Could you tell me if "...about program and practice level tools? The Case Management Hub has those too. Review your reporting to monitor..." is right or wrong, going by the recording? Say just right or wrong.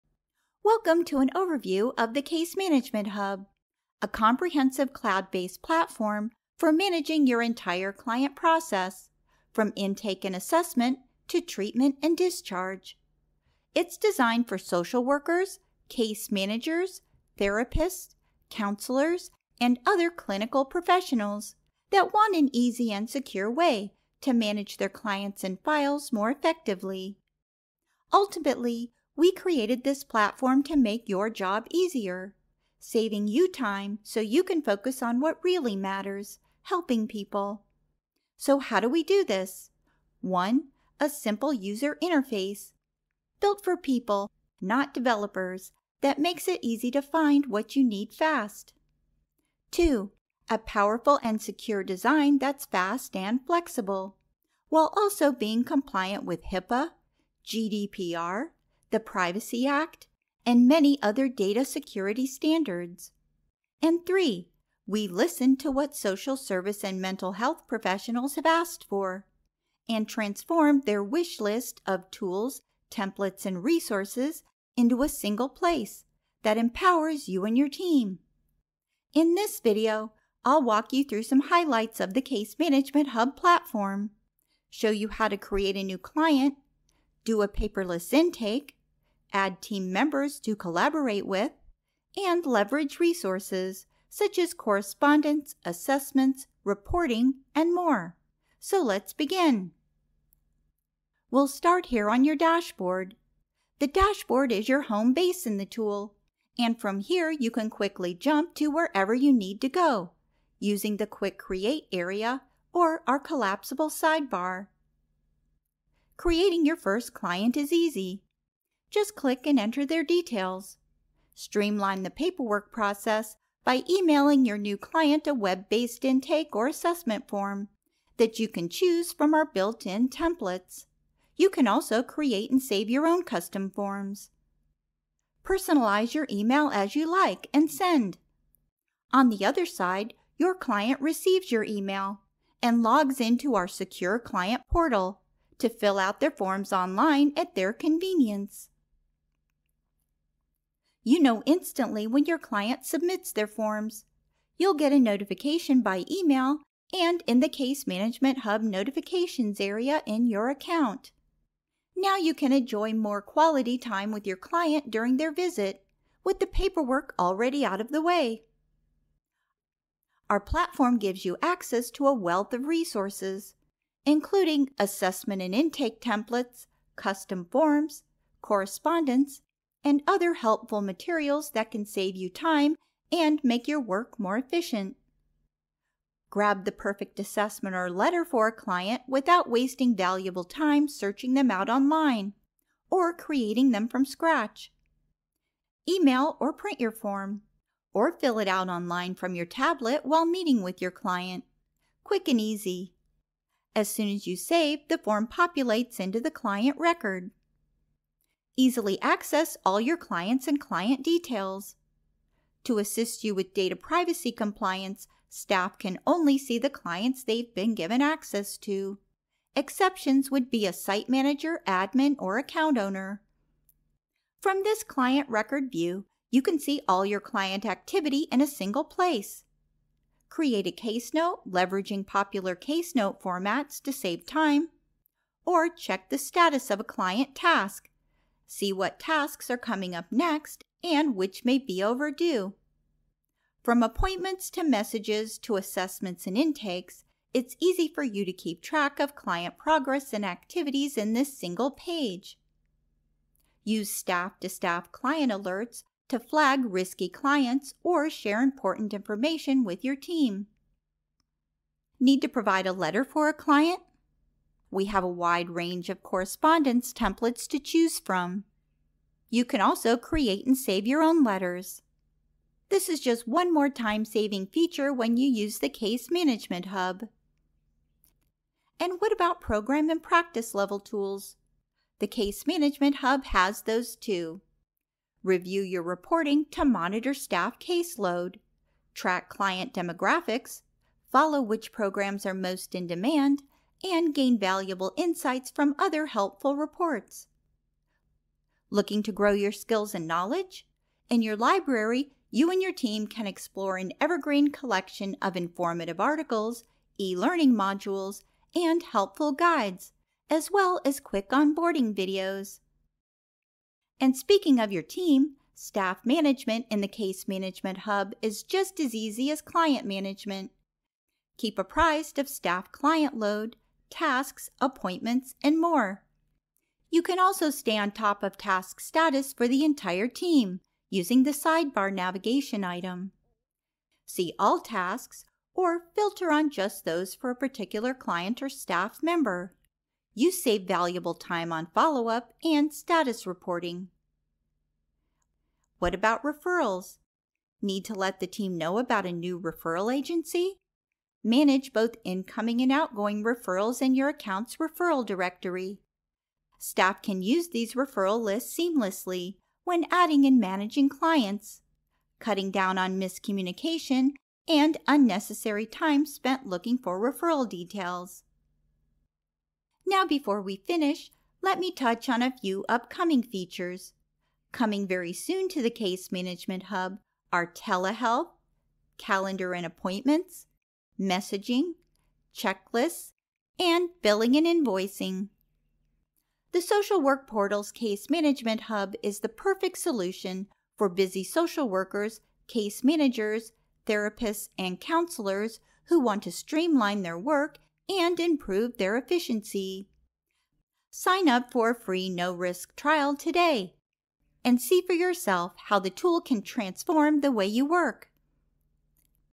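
right.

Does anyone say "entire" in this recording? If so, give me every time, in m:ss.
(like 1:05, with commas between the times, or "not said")
0:07, 5:29.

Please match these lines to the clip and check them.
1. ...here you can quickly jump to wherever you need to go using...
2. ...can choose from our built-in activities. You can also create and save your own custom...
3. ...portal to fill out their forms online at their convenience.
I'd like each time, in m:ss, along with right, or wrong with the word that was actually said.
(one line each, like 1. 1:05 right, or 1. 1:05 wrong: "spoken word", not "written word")
1. 1:46 right
2. 2:08 wrong: "templates", not "activities"
3. 2:24 right.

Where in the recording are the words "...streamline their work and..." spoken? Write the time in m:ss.
6:36.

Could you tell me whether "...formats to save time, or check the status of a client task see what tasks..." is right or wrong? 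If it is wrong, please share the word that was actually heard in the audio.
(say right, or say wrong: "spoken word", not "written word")
right.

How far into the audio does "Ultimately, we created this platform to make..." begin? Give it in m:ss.
0:28.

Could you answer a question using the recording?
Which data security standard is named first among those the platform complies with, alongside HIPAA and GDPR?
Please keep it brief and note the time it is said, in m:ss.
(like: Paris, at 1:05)
Privacy Act, at 0:58.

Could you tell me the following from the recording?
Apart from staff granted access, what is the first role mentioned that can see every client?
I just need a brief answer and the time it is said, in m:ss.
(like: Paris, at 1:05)
site manager, at 3:40.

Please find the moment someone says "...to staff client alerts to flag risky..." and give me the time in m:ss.
4:14.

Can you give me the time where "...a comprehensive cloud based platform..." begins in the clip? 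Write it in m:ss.
0:03.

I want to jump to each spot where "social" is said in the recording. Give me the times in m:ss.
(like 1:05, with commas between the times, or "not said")
0:14, 1:05, 6:26, 6:31.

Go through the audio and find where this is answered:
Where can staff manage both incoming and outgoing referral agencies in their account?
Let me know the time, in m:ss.
5:54.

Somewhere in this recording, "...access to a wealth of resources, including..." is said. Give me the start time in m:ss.
2:51.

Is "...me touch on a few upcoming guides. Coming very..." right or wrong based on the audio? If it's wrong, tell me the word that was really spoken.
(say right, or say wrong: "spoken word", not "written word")
wrong: "features", not "guides".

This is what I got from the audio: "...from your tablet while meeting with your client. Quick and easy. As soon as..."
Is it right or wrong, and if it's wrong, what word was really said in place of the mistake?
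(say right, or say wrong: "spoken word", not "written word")
right.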